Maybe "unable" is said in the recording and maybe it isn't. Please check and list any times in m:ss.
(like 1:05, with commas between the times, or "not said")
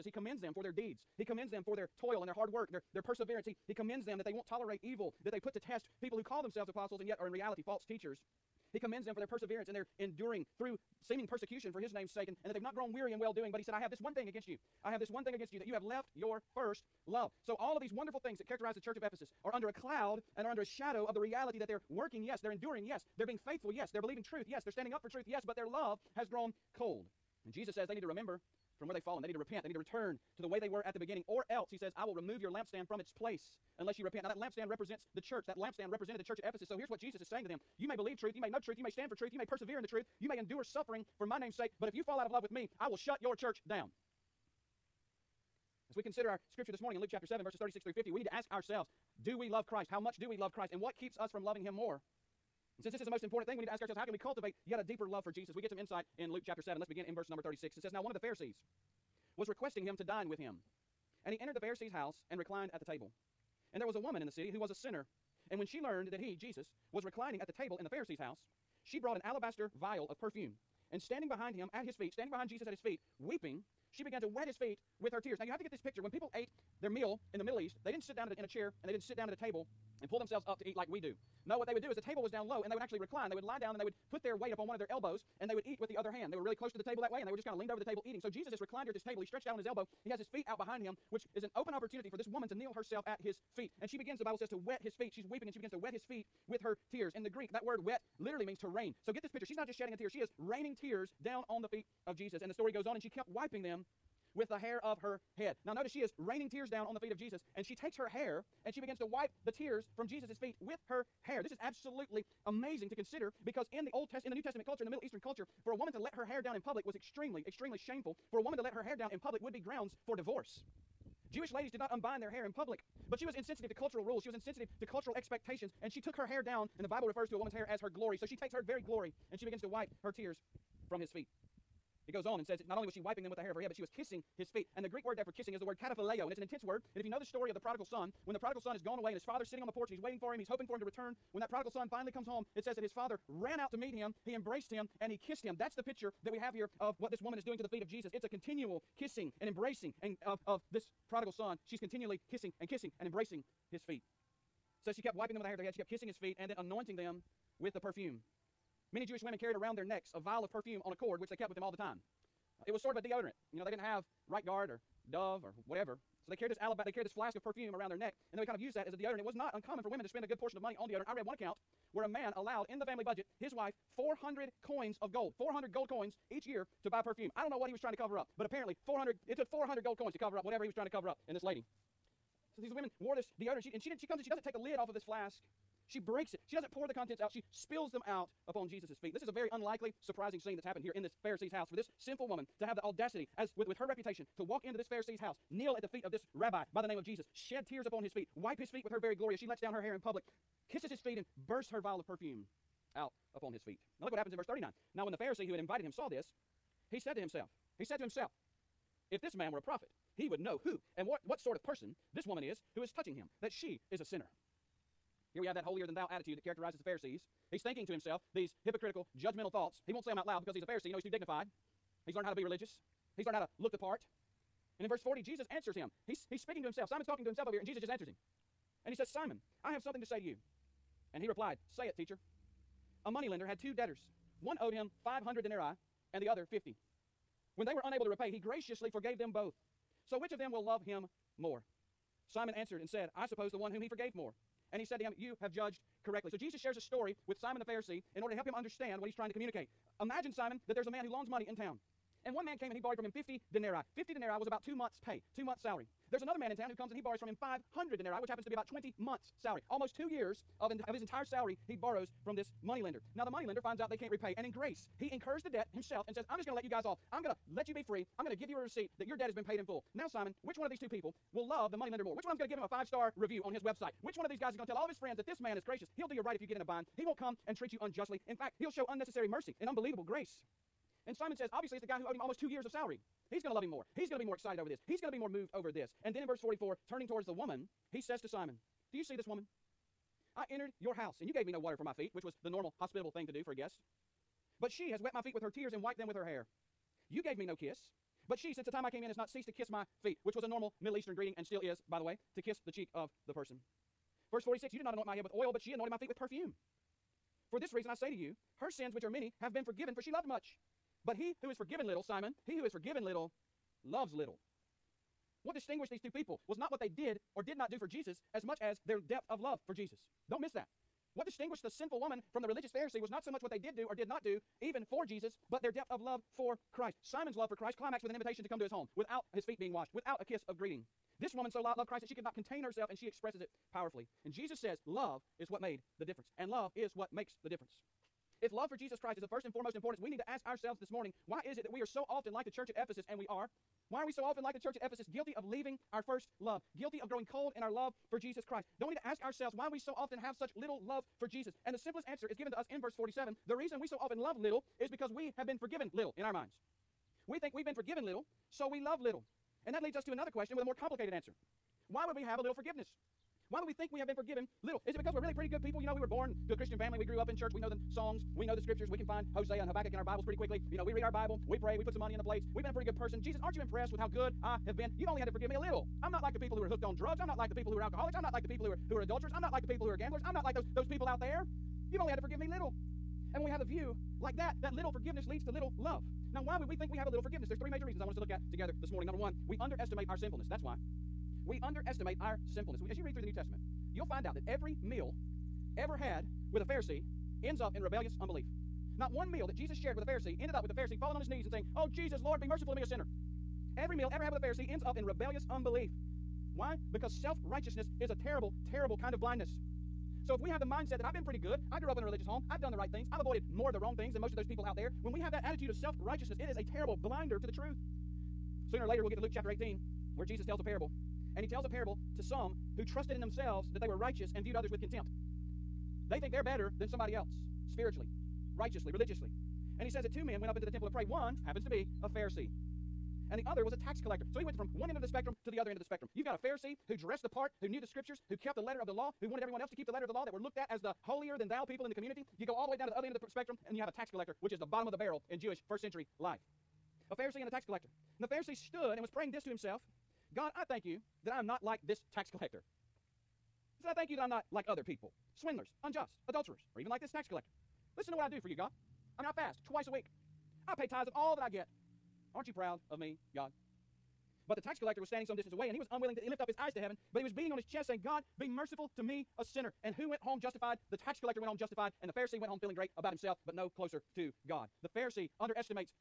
3:57.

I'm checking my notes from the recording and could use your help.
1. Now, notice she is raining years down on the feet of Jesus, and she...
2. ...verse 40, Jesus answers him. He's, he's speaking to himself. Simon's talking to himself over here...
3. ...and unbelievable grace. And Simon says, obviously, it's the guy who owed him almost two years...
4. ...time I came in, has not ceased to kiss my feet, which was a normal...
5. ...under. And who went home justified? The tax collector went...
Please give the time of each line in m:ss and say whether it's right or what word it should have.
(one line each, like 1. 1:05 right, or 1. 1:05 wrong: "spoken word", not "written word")
1. 1:45 wrong: "tears", not "years"
2. 3:44 right
3. 4:39 right
4. 4:58 right
5. 7:49 wrong: "sinner", not "under".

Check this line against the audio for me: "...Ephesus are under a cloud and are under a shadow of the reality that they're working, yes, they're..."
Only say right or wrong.
right.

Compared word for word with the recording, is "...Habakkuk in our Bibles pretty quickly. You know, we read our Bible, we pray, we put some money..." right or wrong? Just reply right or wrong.
right.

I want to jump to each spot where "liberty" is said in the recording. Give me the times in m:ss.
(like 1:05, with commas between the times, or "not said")
not said.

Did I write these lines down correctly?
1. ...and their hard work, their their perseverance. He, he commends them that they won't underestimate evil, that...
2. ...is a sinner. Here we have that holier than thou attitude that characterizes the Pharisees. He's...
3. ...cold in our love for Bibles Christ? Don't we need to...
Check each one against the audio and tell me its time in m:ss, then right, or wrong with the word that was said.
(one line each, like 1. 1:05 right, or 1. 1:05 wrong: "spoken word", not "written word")
1. 0:02 wrong: "tolerate", not "underestimate"
2. 3:33 right
3. 5:47 wrong: "Jesus", not "Bibles".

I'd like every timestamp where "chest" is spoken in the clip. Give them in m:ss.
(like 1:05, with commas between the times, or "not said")
7:47.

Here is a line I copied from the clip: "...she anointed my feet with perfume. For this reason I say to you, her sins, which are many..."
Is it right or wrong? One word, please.
right.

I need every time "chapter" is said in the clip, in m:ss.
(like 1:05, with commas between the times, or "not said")
0:47, 0:56, 6:59.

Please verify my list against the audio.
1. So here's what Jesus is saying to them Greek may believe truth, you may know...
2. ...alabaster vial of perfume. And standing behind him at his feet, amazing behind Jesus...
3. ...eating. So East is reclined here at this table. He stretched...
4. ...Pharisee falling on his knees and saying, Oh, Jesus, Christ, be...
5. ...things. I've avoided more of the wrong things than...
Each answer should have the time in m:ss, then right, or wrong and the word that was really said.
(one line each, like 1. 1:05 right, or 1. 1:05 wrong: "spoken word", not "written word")
1. 0:36 wrong: "You", not "Greek"
2. 1:09 wrong: "standing", not "amazing"
3. 1:28 wrong: "Jesus", not "East"
4. 6:40 wrong: "Lord", not "Christ"
5. 6:52 right.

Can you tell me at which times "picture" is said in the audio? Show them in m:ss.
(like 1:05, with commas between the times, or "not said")
1:15, 1:39, 2:25.